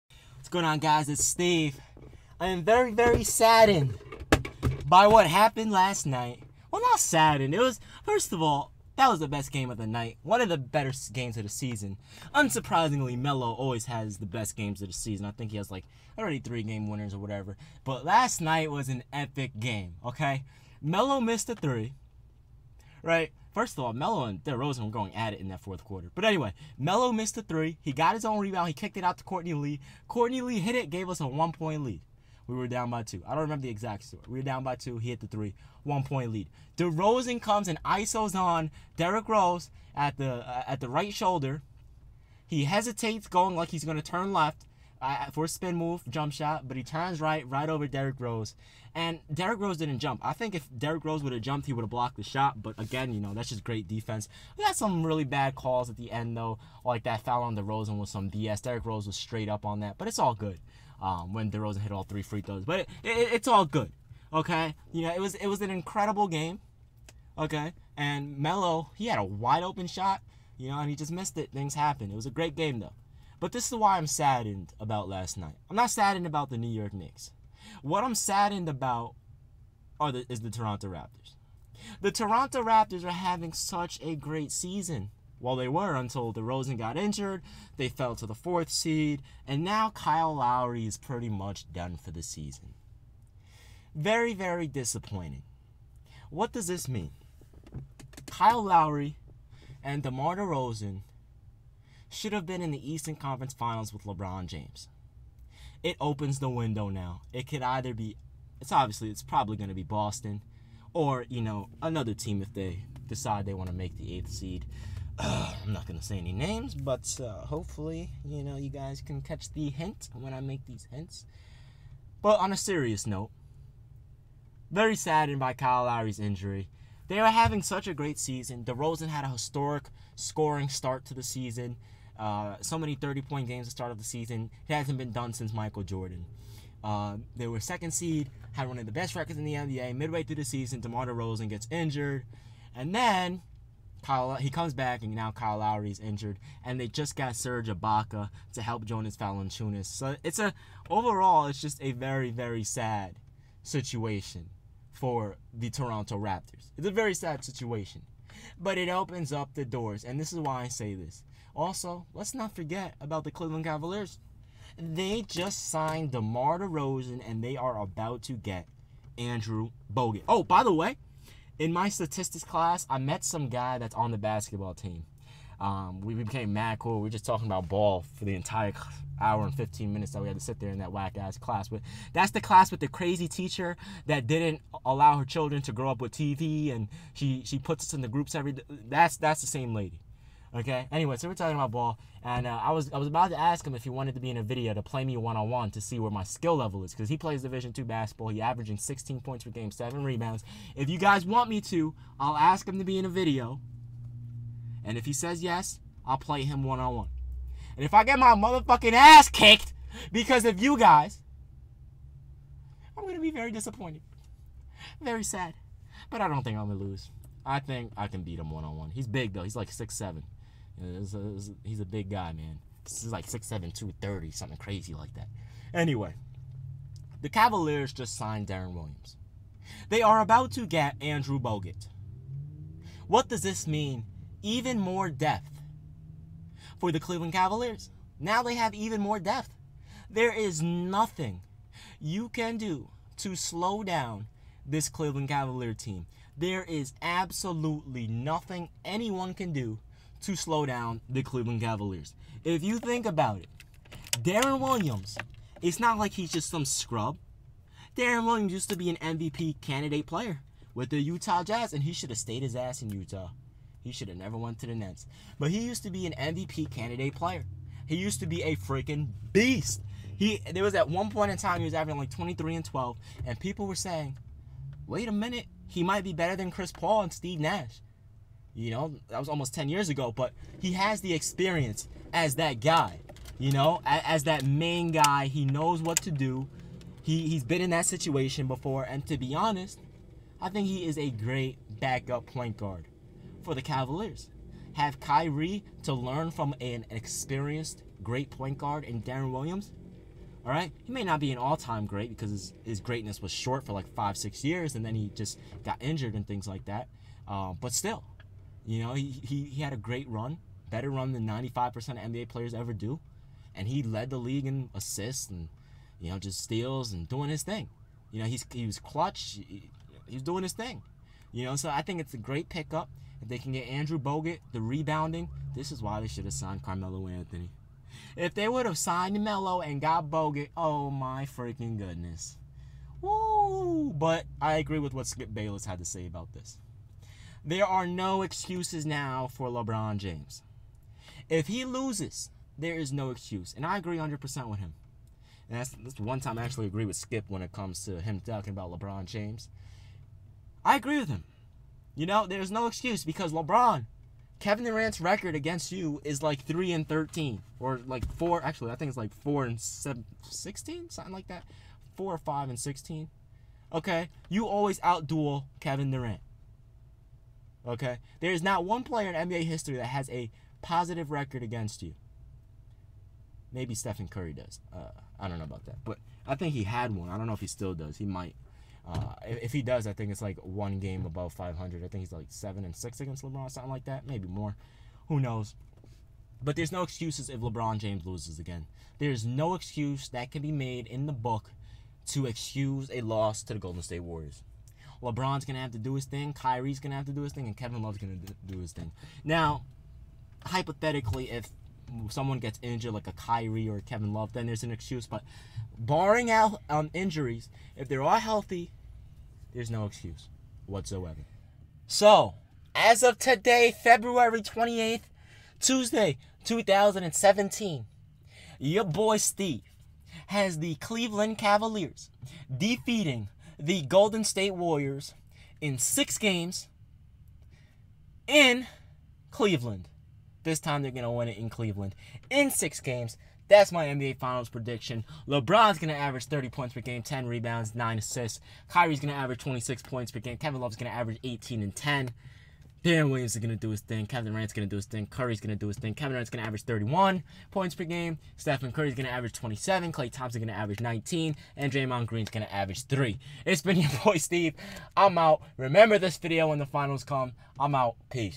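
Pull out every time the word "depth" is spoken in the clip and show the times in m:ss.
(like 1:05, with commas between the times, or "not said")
3:55, 3:59.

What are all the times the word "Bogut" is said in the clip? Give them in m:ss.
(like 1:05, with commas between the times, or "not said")
2:49, 3:51, 5:23, 5:30.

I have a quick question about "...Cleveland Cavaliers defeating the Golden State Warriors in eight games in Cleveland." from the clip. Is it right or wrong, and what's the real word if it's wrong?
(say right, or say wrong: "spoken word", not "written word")
wrong: "six", not "eight".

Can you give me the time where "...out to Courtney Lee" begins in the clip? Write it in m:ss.
0:29.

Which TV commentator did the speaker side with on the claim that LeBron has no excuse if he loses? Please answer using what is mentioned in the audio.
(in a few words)
Skip Bayless.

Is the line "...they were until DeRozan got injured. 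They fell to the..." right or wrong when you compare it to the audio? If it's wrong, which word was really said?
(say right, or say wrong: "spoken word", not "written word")
right.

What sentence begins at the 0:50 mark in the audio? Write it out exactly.
I think if Derrick Rose would have jumped, he would have blocked the shot.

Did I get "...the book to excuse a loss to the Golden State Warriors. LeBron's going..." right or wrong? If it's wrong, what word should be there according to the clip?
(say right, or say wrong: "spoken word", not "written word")
right.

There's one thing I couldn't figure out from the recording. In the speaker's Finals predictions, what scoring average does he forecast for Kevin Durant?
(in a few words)
31.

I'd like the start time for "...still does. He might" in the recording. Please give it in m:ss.
6:17.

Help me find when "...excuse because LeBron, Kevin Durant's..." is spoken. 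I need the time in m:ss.
5:52.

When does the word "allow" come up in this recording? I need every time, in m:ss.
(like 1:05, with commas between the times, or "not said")
3:04.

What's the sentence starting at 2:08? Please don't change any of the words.
DeRozan had a historic scoring start to the season.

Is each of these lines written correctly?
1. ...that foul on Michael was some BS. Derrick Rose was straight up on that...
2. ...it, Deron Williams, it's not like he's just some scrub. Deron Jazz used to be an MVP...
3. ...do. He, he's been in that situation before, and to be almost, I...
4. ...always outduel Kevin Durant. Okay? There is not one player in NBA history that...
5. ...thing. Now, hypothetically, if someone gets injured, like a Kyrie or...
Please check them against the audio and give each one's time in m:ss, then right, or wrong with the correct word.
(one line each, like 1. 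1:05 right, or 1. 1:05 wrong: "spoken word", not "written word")
1. 0:57 wrong: "DeRozan", not "Michael"
2. 4:13 wrong: "Williams", not "Jazz"
3. 4:46 wrong: "honest", not "almost"
4. 6:04 right
5. 6:38 right.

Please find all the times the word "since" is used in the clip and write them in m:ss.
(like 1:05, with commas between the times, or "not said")
2:15.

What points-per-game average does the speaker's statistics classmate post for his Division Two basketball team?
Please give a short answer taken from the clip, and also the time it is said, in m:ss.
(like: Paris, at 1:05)
16, at 3:18.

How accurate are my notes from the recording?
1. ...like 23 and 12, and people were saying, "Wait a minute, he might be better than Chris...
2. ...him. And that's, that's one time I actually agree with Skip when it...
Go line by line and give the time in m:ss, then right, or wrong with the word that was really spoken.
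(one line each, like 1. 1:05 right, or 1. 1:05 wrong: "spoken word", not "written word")
1. 4:31 right
2. 5:44 right.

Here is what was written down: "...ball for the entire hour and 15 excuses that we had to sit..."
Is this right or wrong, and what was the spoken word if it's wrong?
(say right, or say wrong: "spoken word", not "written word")
wrong: "minutes", not "excuses".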